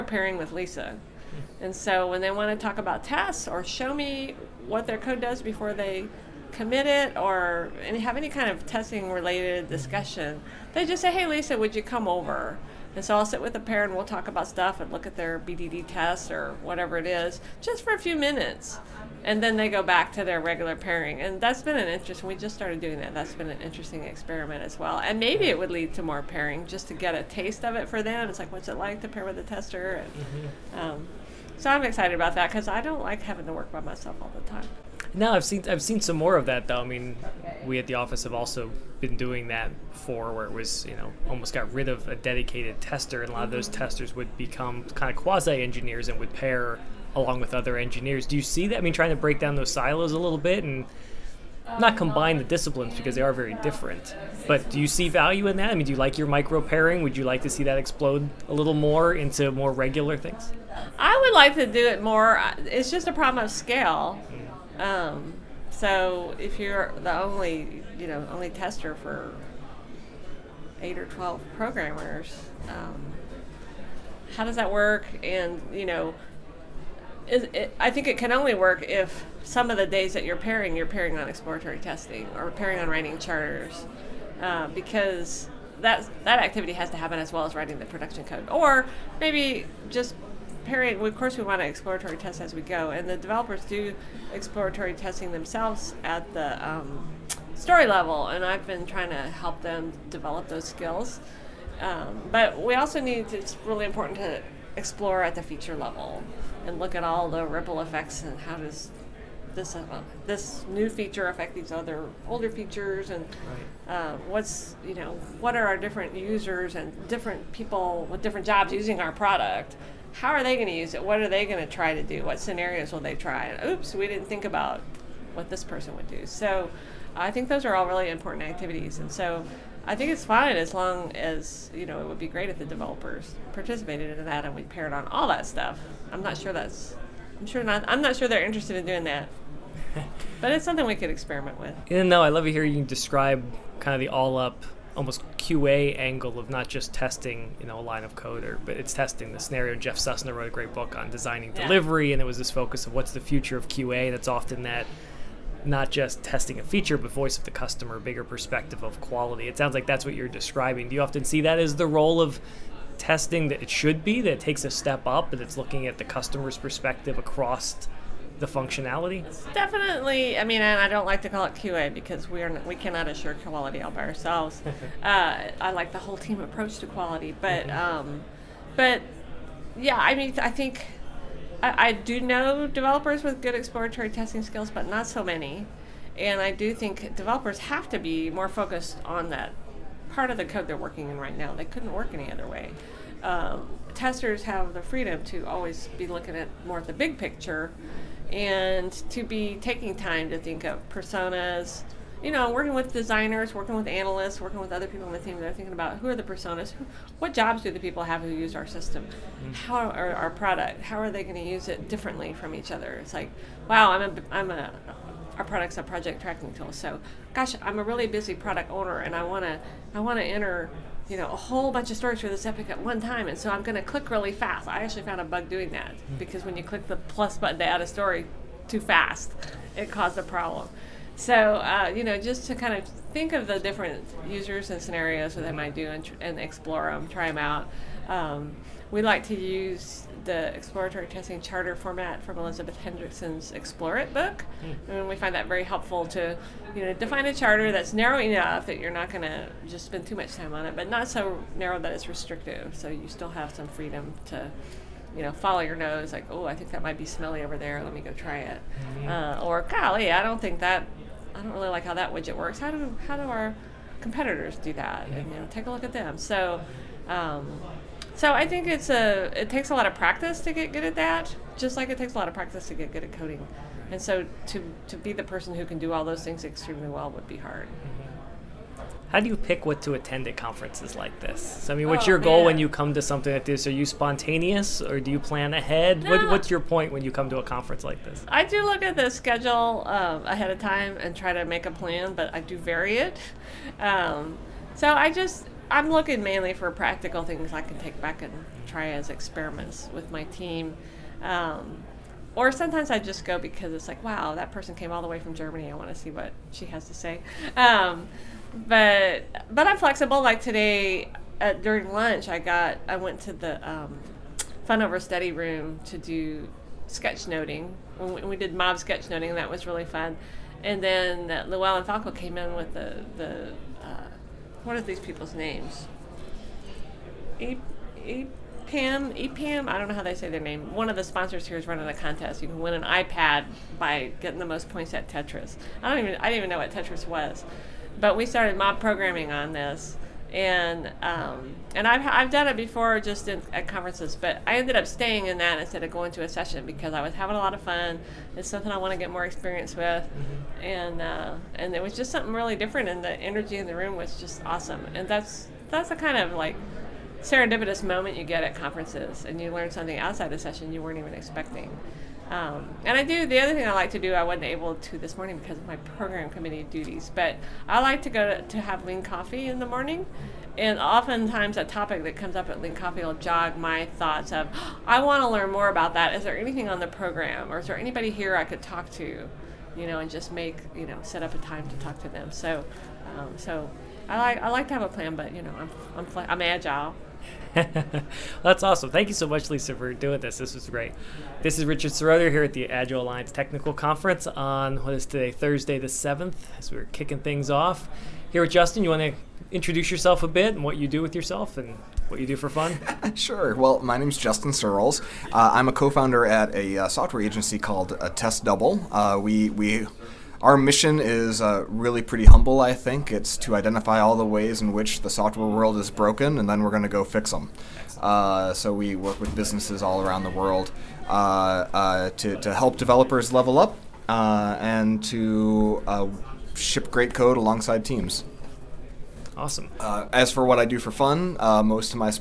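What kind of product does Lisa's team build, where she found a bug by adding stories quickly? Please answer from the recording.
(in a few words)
project tracking tool.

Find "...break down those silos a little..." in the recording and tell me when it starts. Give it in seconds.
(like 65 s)
49 s.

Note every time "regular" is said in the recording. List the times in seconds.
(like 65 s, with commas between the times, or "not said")
20 s, 59 s.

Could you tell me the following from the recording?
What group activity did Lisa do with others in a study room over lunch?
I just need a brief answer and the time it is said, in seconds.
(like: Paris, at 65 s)
mob sketchnoting, at 318 s.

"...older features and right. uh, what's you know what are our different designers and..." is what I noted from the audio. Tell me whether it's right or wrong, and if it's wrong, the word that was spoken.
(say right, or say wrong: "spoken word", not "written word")
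wrong: "users", not "designers".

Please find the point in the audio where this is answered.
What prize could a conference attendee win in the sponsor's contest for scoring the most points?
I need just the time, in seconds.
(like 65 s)
332 s.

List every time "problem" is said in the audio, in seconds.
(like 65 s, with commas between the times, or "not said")
63 s, 230 s.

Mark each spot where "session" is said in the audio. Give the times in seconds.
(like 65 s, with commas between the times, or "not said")
346 s, 360 s.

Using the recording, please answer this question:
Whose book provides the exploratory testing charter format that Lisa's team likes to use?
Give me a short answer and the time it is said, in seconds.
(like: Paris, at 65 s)
Elizabeth Hendrickson, at 242 s.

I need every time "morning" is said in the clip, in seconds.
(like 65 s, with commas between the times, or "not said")
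365 s, 369 s.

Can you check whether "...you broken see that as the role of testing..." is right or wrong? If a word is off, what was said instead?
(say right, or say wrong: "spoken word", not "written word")
wrong: "often", not "broken".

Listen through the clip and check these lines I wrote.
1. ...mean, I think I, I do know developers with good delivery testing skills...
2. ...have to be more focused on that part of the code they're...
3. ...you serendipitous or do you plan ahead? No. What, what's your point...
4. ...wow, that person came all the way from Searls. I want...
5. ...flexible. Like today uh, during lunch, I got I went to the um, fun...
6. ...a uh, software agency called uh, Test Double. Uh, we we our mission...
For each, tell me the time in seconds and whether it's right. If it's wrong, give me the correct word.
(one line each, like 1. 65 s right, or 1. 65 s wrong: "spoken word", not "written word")
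1. 180 s wrong: "exploratory", not "delivery"
2. 187 s right
3. 283 s wrong: "spontaneous", not "serendipitous"
4. 304 s wrong: "Germany", not "Searls"
5. 309 s right
6. 406 s right.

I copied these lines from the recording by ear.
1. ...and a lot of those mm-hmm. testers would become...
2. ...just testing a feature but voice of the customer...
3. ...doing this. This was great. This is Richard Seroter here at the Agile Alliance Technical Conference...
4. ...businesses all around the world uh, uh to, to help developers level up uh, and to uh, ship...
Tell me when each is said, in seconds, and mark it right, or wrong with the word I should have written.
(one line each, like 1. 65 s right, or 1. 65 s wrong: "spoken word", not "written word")
1. 43 s right
2. 155 s right
3. 389 s right
4. 419 s right.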